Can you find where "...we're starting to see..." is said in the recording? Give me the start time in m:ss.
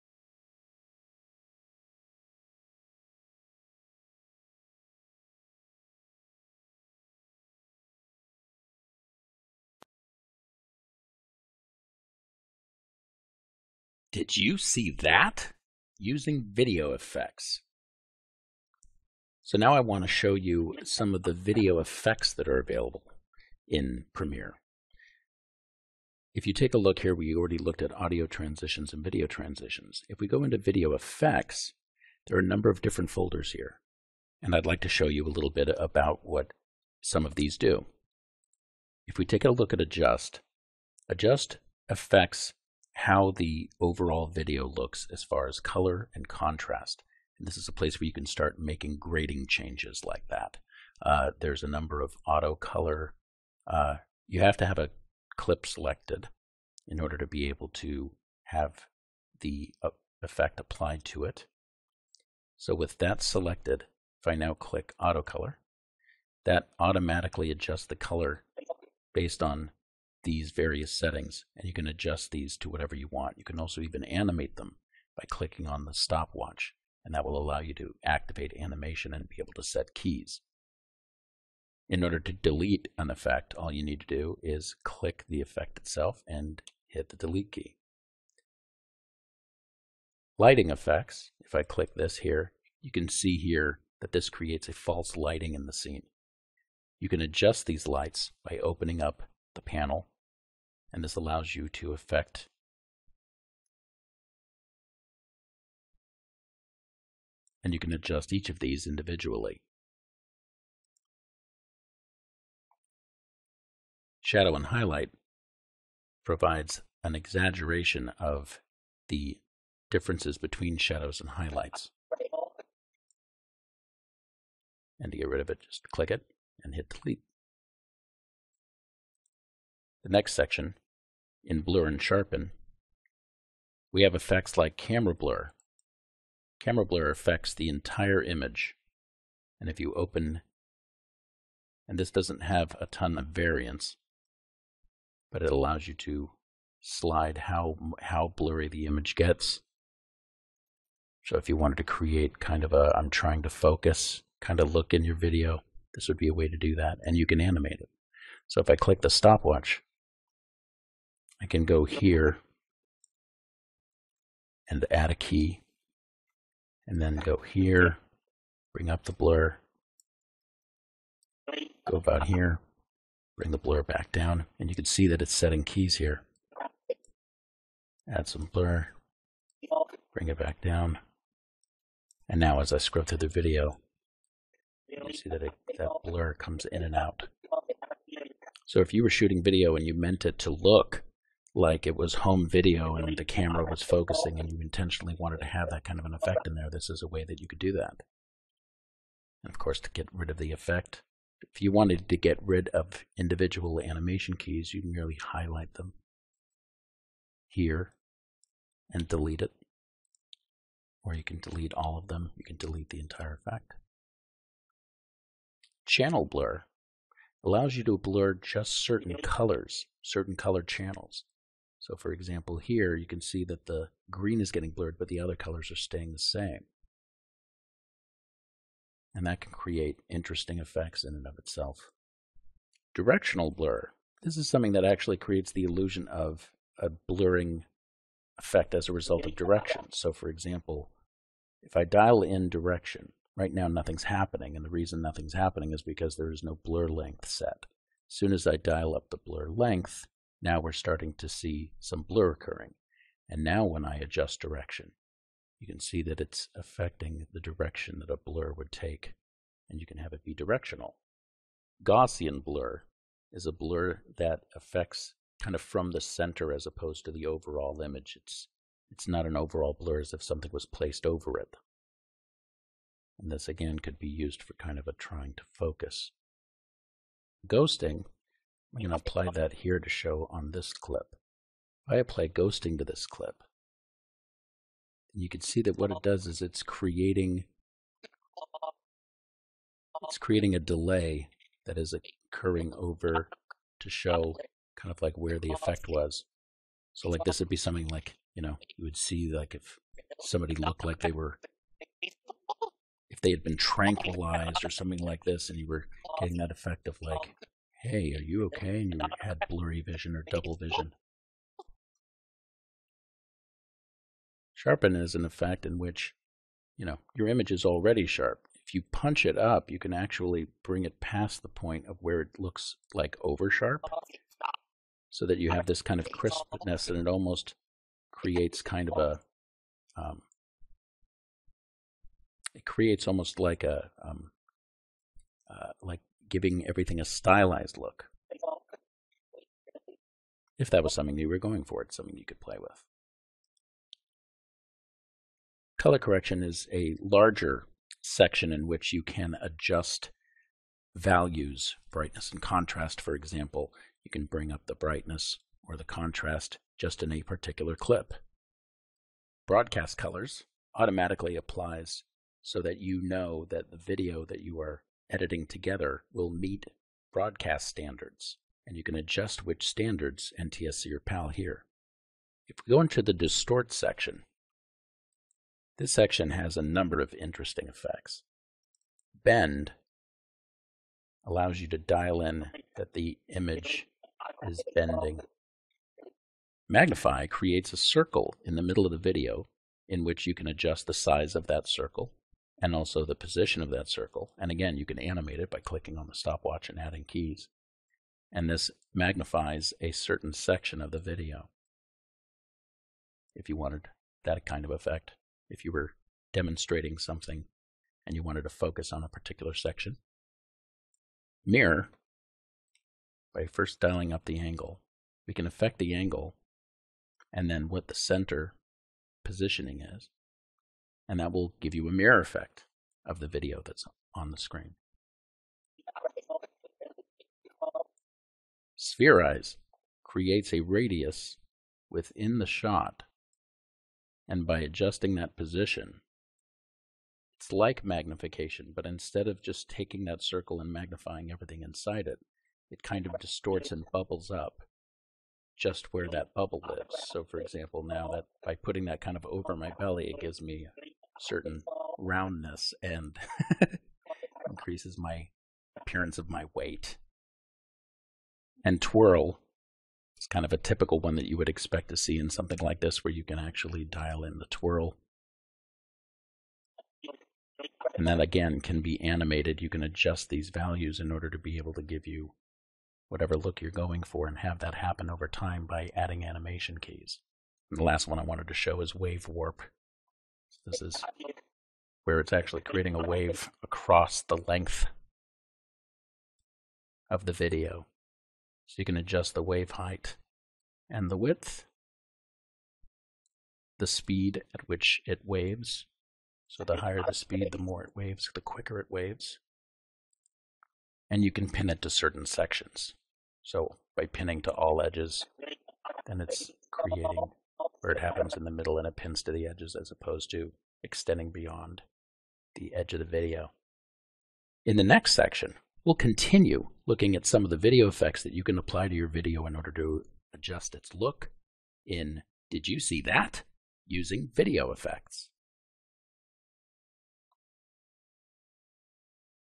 4:10.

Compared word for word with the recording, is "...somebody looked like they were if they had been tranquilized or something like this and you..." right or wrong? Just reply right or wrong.
right.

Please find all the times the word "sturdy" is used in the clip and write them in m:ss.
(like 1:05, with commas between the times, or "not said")
not said.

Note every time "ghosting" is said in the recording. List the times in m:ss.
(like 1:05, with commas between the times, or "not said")
4:37, 4:42.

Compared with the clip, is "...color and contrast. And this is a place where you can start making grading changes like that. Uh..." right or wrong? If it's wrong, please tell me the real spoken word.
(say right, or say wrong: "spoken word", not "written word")
right.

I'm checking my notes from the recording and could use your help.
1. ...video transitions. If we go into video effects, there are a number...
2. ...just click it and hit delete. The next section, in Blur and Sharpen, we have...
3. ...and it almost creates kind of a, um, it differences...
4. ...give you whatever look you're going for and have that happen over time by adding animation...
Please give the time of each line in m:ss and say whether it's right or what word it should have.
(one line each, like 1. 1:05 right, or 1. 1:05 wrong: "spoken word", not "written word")
1. 0:29 right
2. 2:05 right
3. 5:26 wrong: "creates", not "differences"
4. 7:51 right.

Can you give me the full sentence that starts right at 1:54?
Shadow and Highlight provides an exaggeration of the differences between shadows and highlights.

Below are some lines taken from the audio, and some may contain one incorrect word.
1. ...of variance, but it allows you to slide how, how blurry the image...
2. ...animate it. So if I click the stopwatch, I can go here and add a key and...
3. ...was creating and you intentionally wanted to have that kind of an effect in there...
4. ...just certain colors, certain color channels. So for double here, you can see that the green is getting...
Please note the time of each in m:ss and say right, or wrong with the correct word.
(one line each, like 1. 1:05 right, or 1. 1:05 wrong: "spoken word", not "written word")
1. 2:23 right
2. 2:37 right
3. 3:13 wrong: "focusing", not "creating"
4. 3:38 wrong: "example", not "double".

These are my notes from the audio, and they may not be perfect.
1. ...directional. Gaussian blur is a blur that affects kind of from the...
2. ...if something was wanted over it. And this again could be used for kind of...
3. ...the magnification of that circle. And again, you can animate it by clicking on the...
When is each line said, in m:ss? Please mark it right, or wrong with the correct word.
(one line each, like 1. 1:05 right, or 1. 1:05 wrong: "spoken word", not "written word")
1. 4:20 right
2. 4:30 wrong: "placed", not "wanted"
3. 6:33 wrong: "position", not "magnification".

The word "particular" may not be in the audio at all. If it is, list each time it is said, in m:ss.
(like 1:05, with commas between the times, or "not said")
5:57, 6:49.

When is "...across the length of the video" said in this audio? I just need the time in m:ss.
8:03.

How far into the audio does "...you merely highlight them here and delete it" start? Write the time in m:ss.
3:24.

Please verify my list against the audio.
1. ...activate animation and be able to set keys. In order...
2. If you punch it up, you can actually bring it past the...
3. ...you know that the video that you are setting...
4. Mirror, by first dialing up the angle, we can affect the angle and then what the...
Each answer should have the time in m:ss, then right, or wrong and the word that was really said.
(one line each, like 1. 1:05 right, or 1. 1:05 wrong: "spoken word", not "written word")
1. 1:18 right
2. 5:18 right
3. 6:02 wrong: "editing", not "setting"
4. 6:51 right.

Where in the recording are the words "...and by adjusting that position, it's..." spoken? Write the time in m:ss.
7:14.